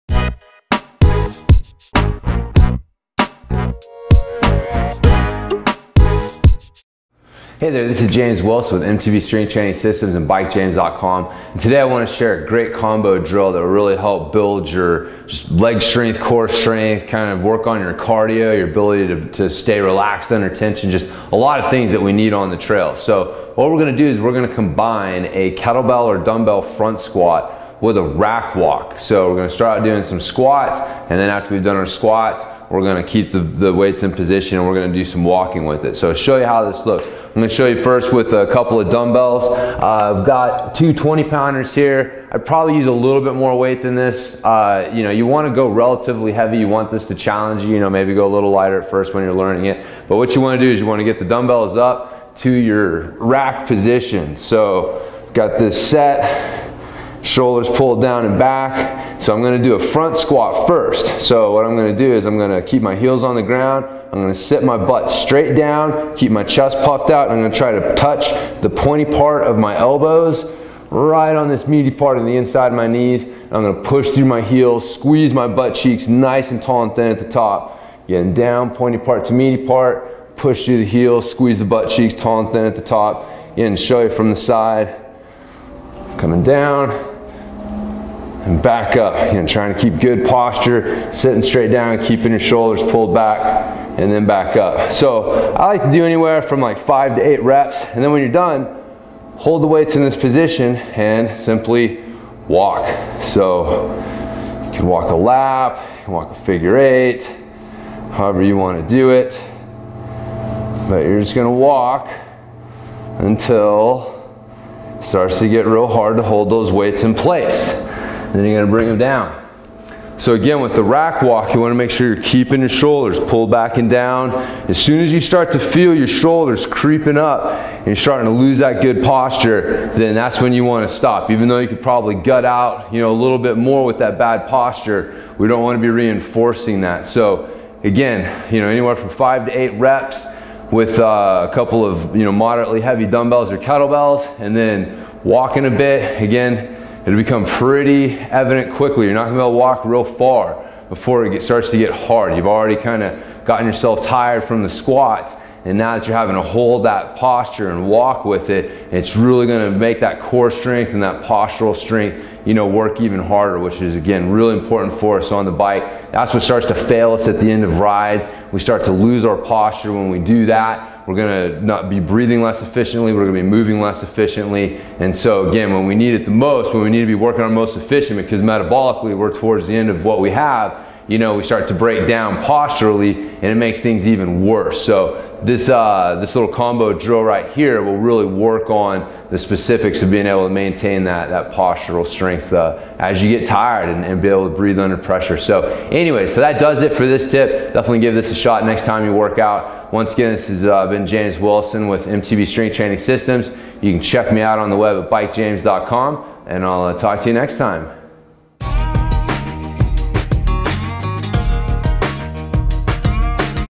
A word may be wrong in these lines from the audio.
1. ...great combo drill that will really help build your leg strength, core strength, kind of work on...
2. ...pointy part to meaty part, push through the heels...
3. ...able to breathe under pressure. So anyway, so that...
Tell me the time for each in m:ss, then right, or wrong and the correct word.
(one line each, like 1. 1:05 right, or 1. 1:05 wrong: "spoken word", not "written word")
1. 0:12 right
2. 1:18 right
3. 3:14 right.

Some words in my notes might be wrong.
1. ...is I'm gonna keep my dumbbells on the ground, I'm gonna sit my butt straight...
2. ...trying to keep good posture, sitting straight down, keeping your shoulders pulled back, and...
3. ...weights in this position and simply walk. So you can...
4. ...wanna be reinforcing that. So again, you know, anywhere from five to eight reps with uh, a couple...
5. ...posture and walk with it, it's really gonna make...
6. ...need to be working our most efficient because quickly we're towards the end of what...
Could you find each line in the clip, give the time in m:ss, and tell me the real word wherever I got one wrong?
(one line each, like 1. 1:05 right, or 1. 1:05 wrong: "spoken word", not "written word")
1. 1:02 wrong: "heels", not "dumbbells"
2. 1:29 right
3. 1:39 right
4. 2:15 right
5. 2:37 right
6. 2:56 wrong: "metabolically", not "quickly".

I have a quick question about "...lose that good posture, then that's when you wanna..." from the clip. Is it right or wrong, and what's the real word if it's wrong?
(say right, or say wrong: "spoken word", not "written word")
right.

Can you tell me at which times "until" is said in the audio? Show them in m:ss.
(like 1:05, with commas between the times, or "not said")
1:53.